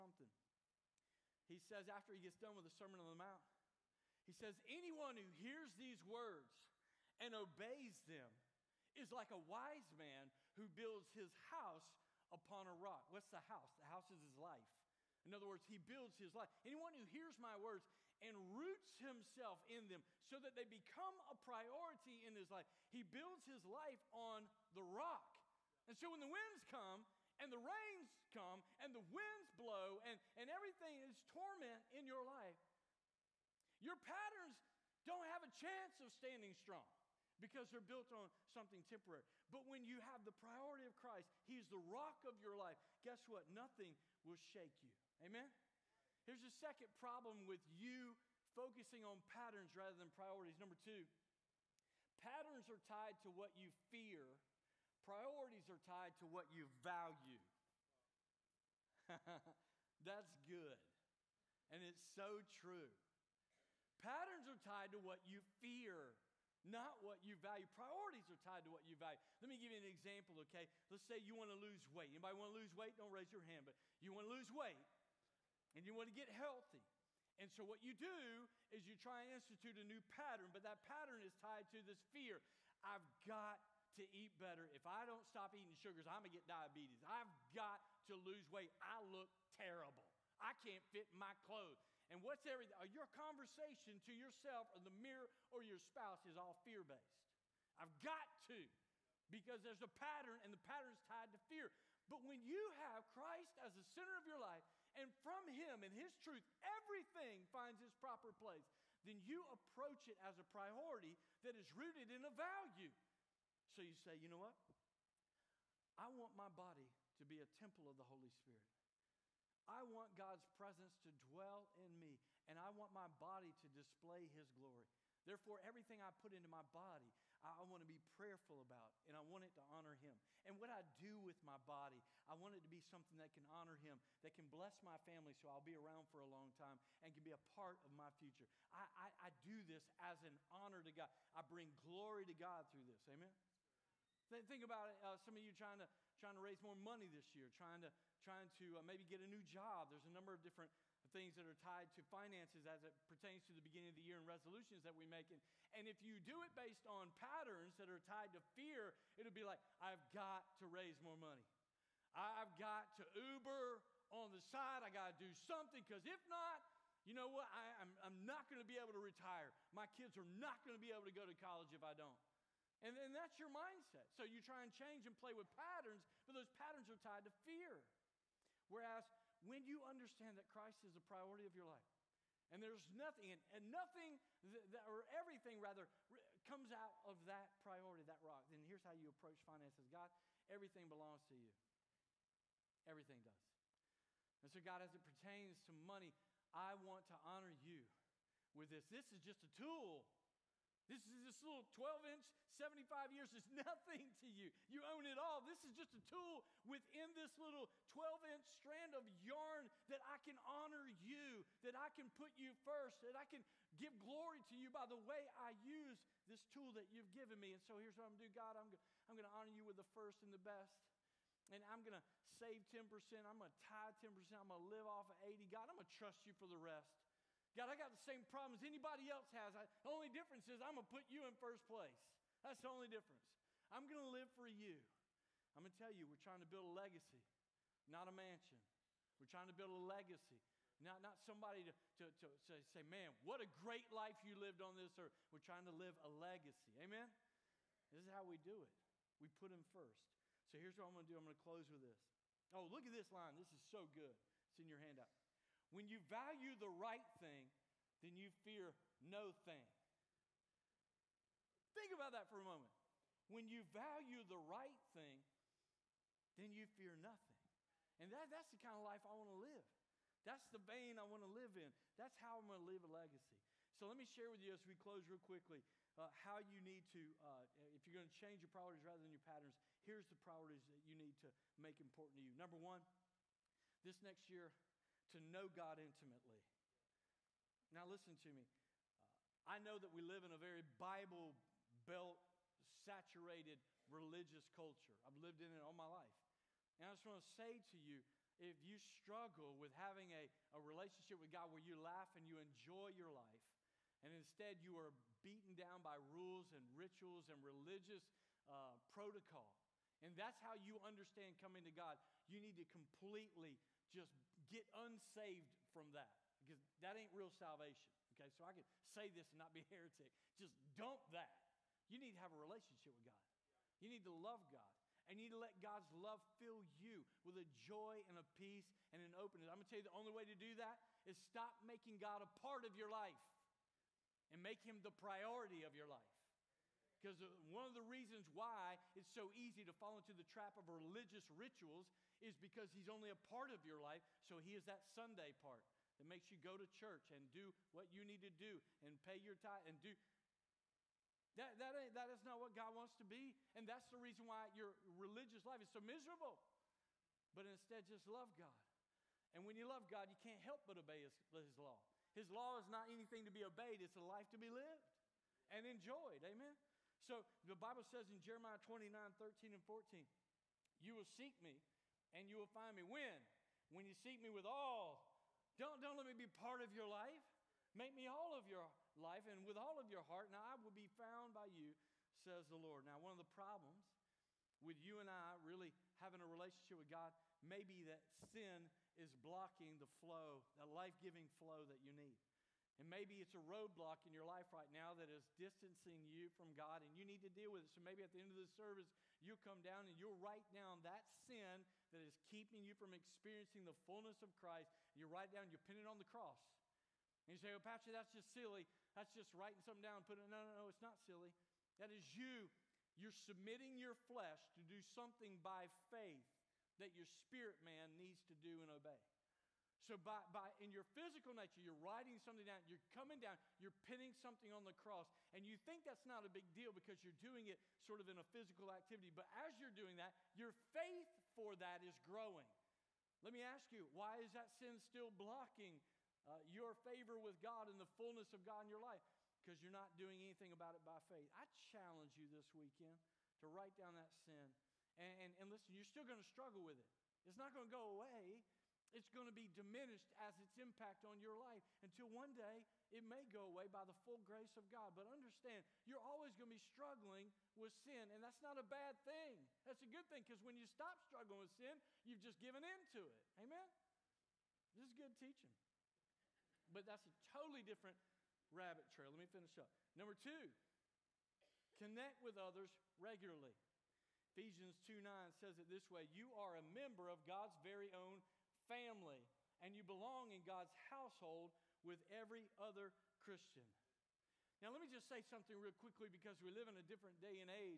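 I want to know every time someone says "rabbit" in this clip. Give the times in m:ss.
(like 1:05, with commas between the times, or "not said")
7:48.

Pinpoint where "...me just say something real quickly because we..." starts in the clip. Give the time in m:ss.
8:04.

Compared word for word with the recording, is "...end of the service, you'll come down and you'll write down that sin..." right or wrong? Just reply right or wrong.
right.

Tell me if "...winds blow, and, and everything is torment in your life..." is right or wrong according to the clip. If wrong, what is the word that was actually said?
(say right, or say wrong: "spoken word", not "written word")
right.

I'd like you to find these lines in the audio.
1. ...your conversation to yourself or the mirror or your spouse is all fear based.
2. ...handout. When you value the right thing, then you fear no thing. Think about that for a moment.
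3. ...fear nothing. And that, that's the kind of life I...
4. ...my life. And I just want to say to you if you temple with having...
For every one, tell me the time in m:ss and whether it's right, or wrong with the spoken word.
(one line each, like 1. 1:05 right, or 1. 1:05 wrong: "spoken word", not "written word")
1. 1:32 right
2. 4:14 right
3. 4:26 right
4. 4:55 wrong: "struggle", not "temple".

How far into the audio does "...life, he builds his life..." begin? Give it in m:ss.
0:22.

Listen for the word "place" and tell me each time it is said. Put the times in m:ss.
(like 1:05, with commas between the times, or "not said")
1:48, 3:51.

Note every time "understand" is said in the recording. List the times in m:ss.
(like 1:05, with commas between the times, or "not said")
2:59, 5:10, 7:35.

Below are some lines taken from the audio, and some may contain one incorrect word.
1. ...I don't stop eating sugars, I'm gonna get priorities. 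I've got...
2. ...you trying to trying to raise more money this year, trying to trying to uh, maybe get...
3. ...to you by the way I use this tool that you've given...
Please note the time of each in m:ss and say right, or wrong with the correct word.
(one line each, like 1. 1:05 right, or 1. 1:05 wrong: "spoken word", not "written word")
1. 1:24 wrong: "diabetes", not "priorities"
2. 2:25 right
3. 3:34 right.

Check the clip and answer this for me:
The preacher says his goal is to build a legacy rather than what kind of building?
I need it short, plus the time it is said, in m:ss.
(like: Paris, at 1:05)
A mansion, at 3:58.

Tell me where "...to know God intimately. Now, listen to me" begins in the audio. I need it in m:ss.
4:45.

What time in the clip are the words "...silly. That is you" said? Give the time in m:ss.
6:50.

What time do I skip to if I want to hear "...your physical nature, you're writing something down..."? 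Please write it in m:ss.
7:00.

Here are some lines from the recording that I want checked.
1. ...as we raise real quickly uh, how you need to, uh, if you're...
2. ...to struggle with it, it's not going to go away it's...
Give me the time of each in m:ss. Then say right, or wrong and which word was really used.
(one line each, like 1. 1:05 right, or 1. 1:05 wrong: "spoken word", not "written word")
1. 4:34 wrong: "close", not "raise"
2. 7:26 right.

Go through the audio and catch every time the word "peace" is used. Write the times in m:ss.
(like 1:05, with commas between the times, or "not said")
5:28.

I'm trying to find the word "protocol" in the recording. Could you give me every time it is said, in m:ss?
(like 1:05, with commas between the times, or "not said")
5:08.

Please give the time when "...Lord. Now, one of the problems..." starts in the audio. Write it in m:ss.
6:22.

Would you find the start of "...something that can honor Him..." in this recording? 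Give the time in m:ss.
2:12.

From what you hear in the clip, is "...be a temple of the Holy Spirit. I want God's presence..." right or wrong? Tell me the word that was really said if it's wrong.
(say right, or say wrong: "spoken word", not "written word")
right.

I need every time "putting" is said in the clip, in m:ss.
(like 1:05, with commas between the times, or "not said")
6:50.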